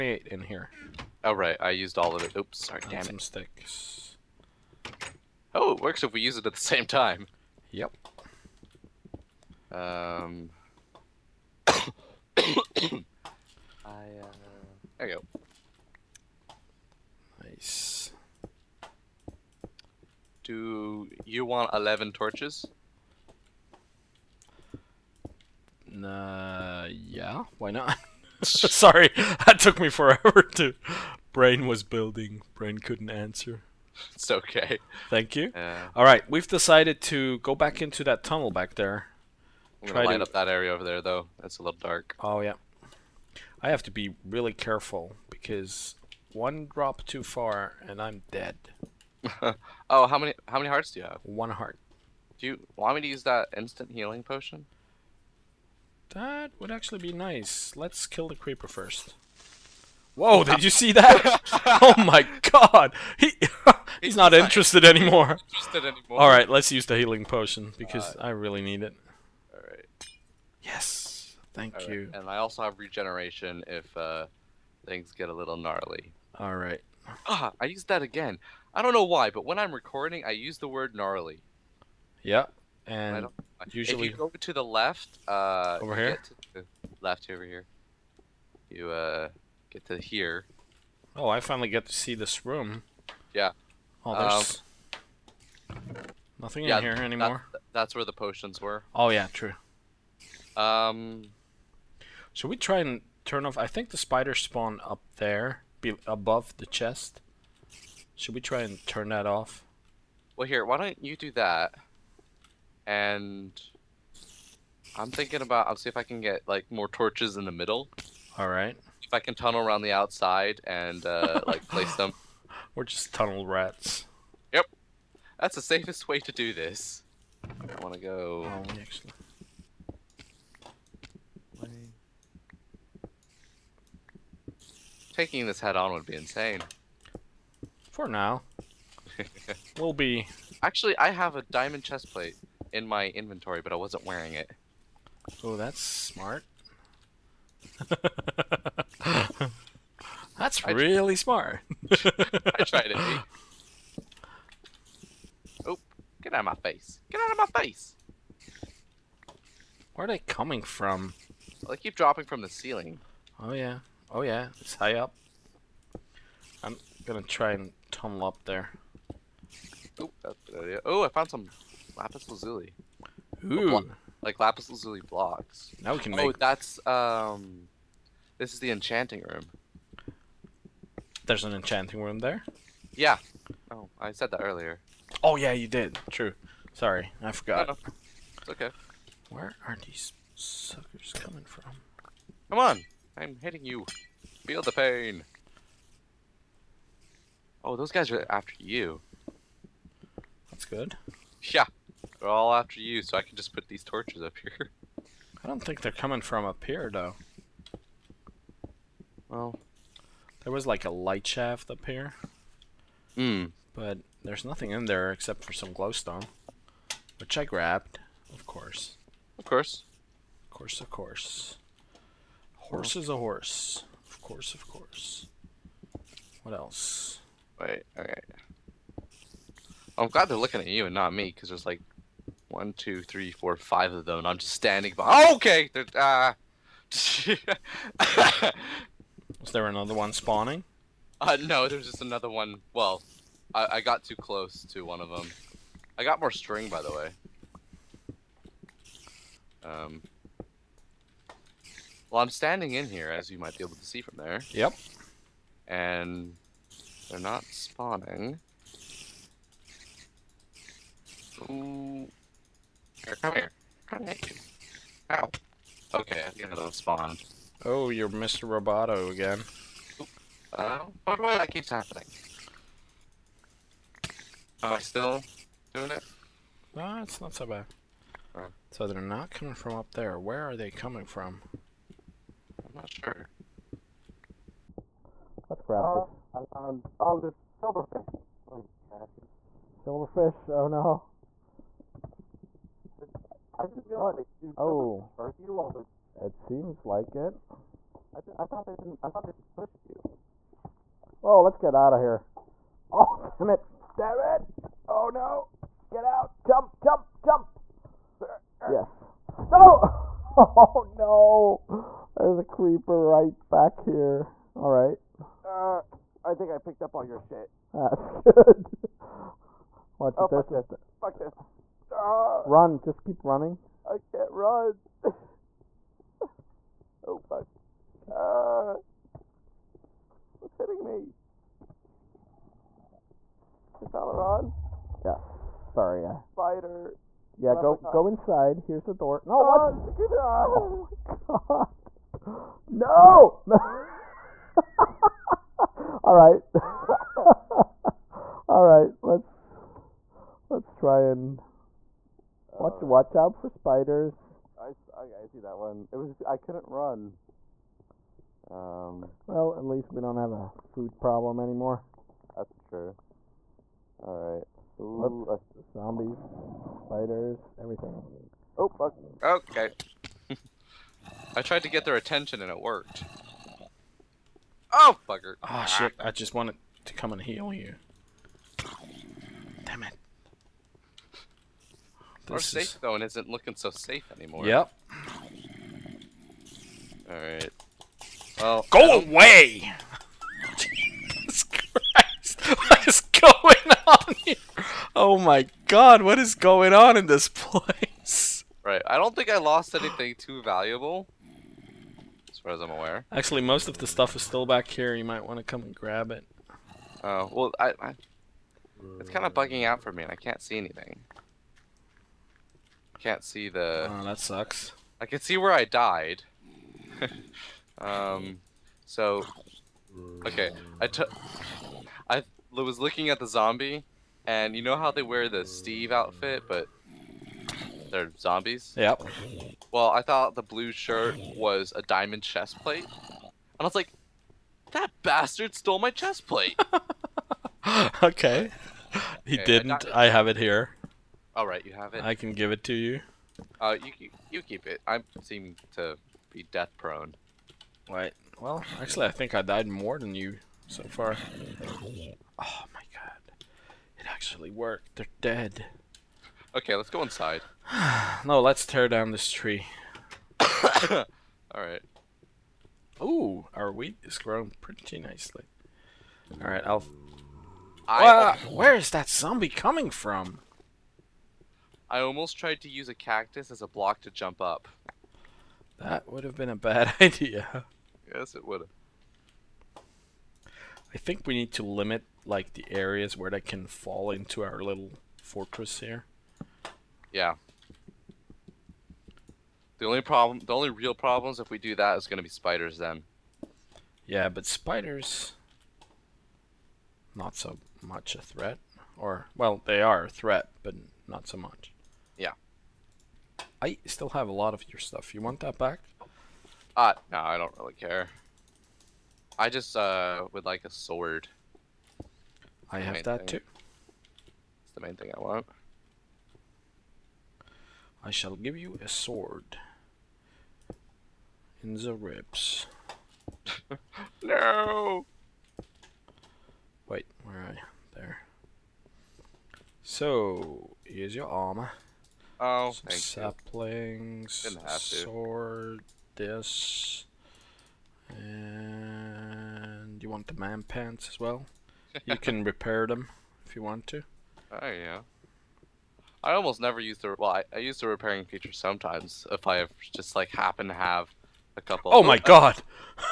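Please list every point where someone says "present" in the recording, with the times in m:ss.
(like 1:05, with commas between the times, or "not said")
not said.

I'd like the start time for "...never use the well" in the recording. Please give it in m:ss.
9:06.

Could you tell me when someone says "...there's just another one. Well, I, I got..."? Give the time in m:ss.
4:01.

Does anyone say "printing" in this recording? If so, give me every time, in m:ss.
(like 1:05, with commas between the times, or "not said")
not said.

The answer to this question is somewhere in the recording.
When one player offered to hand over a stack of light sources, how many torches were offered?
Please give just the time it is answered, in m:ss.
0:21.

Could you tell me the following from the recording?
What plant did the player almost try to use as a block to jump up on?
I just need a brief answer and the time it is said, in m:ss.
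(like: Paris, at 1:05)
Cactus, at 7:52.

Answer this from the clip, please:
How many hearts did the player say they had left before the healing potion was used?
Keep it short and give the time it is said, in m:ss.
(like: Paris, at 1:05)
1, at 0:51.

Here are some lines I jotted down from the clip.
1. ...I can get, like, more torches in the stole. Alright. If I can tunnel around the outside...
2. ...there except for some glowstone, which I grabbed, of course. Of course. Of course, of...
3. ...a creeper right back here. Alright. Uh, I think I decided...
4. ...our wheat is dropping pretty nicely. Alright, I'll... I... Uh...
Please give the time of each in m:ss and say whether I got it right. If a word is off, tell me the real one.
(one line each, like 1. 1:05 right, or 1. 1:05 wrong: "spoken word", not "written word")
1. 1:55 wrong: "middle", not "stole"
2. 3:34 right
3. 5:12 wrong: "picked", not "decided"
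4. 7:43 wrong: "growing", not "dropping".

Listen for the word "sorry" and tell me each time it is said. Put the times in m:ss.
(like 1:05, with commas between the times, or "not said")
0:02, 0:28, 3:06, 5:35.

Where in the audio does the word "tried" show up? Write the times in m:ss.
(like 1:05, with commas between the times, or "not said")
2:32, 6:11, 7:52.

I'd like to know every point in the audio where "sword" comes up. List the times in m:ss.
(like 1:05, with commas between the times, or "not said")
8:30, 8:38, 8:54.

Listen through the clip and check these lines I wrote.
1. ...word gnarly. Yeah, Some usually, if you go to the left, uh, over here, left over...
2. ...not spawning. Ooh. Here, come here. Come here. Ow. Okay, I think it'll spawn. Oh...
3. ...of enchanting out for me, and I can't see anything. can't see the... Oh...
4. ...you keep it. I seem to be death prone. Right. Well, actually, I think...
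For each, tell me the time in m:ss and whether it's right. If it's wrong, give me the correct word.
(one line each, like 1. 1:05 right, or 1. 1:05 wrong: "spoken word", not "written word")
1. 1:20 wrong: "And", not "Some"
2. 4:17 right
3. 6:49 wrong: "bugging", not "enchanting"
4. 7:24 right.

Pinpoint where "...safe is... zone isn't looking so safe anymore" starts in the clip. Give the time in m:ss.
6:22.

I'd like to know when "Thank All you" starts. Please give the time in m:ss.
1:11.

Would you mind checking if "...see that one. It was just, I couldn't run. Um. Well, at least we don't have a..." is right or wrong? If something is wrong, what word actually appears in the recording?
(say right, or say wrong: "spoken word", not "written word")
right.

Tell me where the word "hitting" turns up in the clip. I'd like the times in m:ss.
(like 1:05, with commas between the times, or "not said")
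3:13, 5:30.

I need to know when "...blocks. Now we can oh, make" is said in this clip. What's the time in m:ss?
2:54.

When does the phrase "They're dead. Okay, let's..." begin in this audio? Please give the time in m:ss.
7:34.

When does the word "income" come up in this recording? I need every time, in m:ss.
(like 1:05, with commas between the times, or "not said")
not said.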